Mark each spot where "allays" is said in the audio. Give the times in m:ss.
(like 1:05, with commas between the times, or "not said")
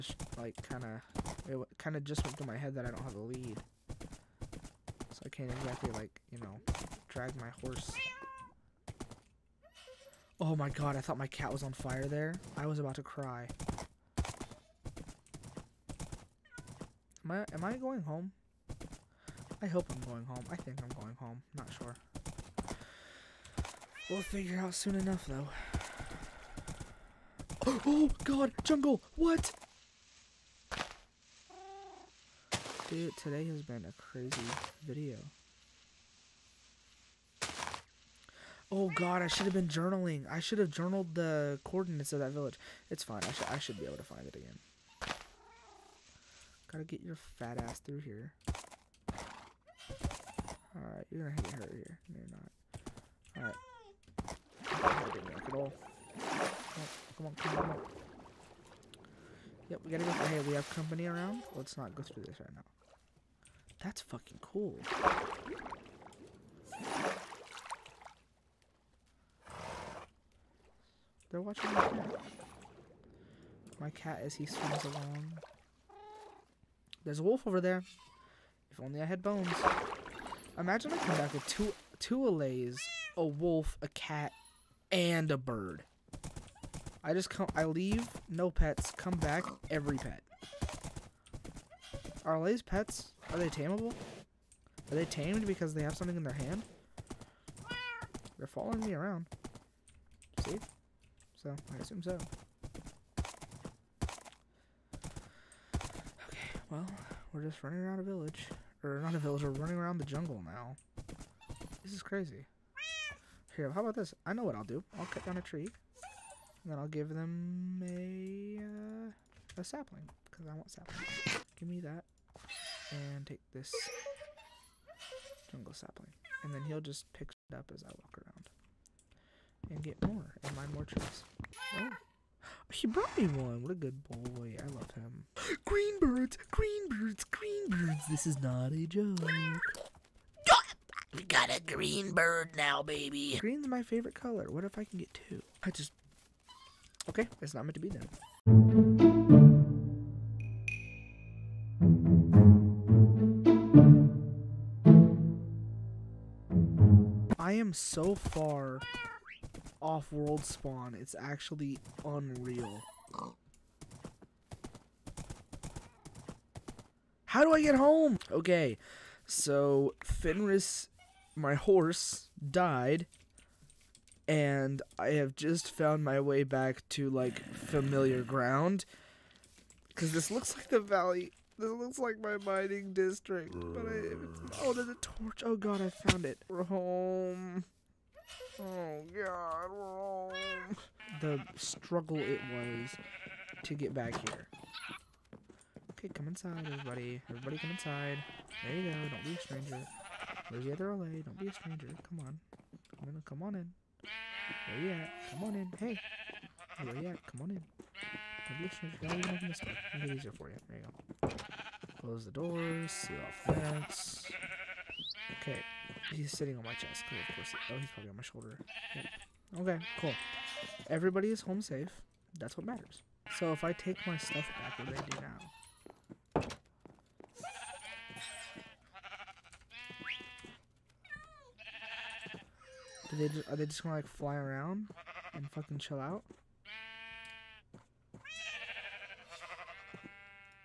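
1:22, 1:32, 3:20.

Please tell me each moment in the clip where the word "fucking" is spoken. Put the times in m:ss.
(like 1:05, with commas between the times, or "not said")
1:04, 3:55.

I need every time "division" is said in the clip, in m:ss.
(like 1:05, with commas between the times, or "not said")
not said.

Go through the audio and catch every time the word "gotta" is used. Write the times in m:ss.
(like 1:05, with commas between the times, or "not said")
0:46, 0:59.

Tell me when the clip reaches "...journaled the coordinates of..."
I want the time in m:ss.
0:40.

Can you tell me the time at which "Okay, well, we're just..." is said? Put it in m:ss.
1:45.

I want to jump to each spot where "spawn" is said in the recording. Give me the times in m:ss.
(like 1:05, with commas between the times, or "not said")
2:40.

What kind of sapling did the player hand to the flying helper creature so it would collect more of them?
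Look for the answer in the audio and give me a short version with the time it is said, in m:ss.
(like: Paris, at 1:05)
Jungle sapling, at 2:05.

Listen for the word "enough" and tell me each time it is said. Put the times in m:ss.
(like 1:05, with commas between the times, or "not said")
0:24.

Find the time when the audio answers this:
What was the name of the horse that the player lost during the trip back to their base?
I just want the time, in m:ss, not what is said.
2:50.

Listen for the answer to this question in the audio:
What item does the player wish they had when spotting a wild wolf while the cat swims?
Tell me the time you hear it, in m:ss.
1:19.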